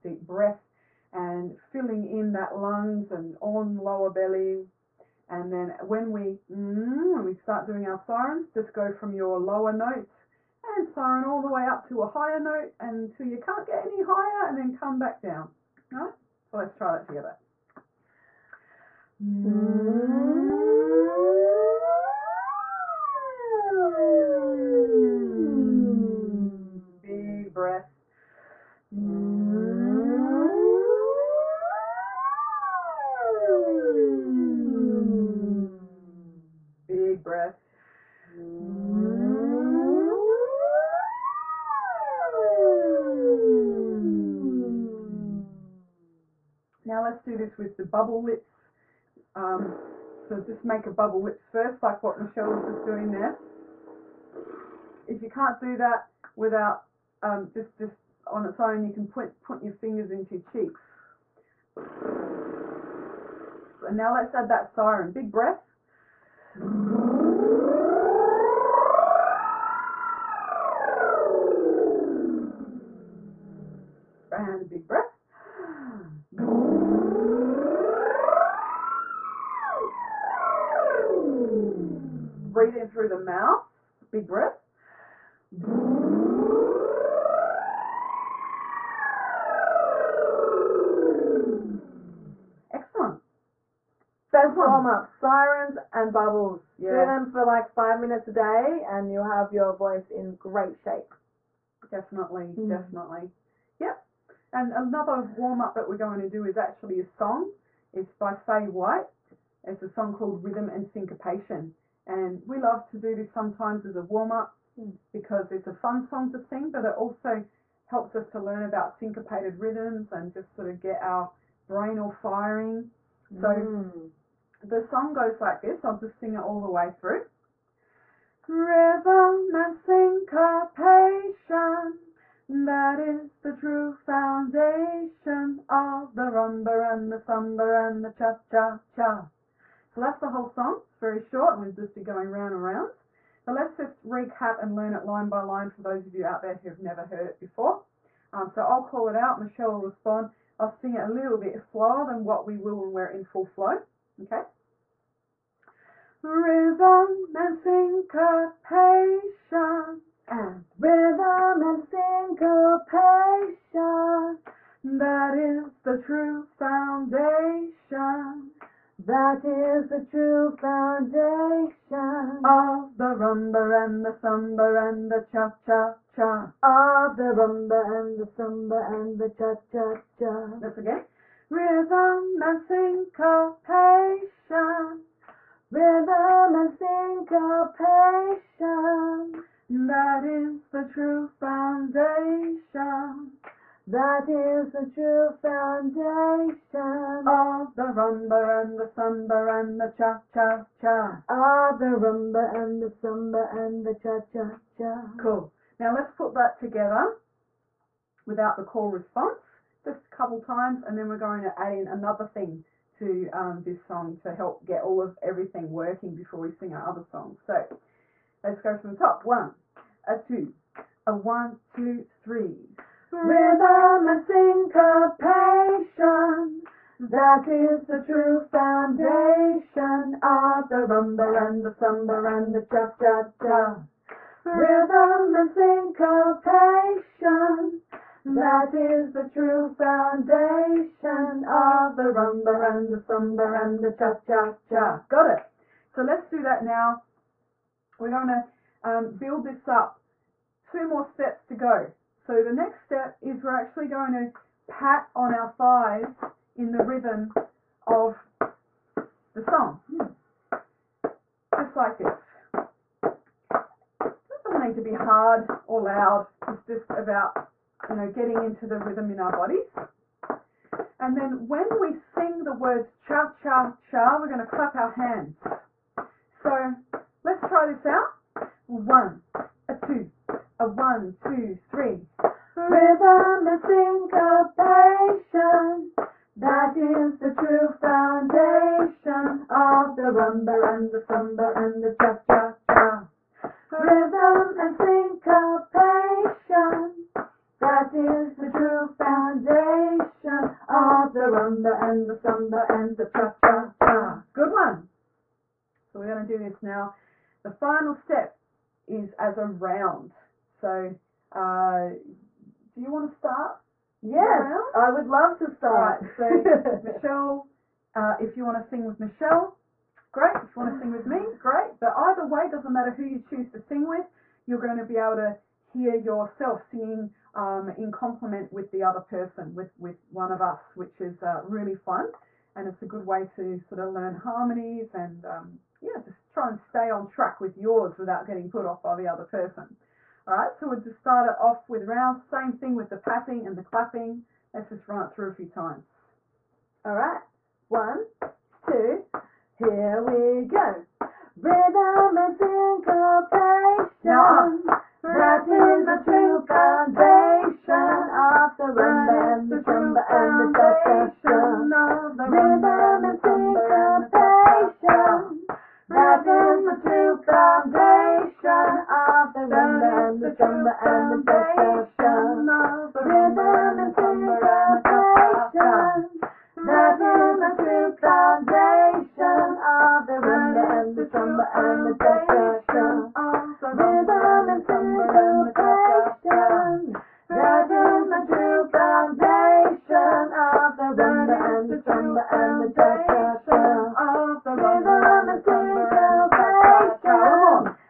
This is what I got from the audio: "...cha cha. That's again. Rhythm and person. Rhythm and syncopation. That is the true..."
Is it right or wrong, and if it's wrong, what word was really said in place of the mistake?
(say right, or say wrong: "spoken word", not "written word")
wrong: "syncopation", not "person".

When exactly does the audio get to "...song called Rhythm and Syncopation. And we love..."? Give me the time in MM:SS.
01:49.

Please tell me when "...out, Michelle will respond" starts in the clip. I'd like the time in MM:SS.
02:29.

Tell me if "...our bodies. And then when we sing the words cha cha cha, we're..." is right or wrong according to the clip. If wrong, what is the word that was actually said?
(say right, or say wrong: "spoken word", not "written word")
right.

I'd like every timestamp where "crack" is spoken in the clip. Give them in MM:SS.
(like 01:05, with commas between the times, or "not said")
not said.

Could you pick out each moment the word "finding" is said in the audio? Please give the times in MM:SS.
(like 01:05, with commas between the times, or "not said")
not said.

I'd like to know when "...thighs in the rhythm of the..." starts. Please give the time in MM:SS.
04:15.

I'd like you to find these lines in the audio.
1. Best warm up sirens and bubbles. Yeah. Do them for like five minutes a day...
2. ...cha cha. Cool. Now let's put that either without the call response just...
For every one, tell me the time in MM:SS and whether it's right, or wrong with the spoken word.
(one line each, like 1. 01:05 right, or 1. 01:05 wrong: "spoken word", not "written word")
1. 01:34 right
2. 03:24 wrong: "together", not "either".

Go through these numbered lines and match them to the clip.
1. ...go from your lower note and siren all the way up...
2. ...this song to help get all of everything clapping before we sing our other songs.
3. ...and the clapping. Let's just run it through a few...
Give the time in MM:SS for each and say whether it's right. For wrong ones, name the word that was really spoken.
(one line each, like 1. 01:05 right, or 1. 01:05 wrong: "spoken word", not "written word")
1. 00:08 right
2. 03:33 wrong: "working", not "clapping"
3. 05:43 right.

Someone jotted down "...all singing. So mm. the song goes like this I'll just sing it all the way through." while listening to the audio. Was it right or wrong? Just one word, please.
wrong.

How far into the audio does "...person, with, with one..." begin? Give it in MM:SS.
05:29.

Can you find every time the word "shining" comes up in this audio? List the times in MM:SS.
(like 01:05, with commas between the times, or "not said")
not said.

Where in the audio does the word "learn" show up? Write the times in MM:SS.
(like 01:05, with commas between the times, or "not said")
01:58, 02:24, 05:33.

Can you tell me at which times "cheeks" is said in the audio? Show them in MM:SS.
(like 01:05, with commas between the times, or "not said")
01:00.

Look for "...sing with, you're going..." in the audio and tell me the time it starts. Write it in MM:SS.
05:23.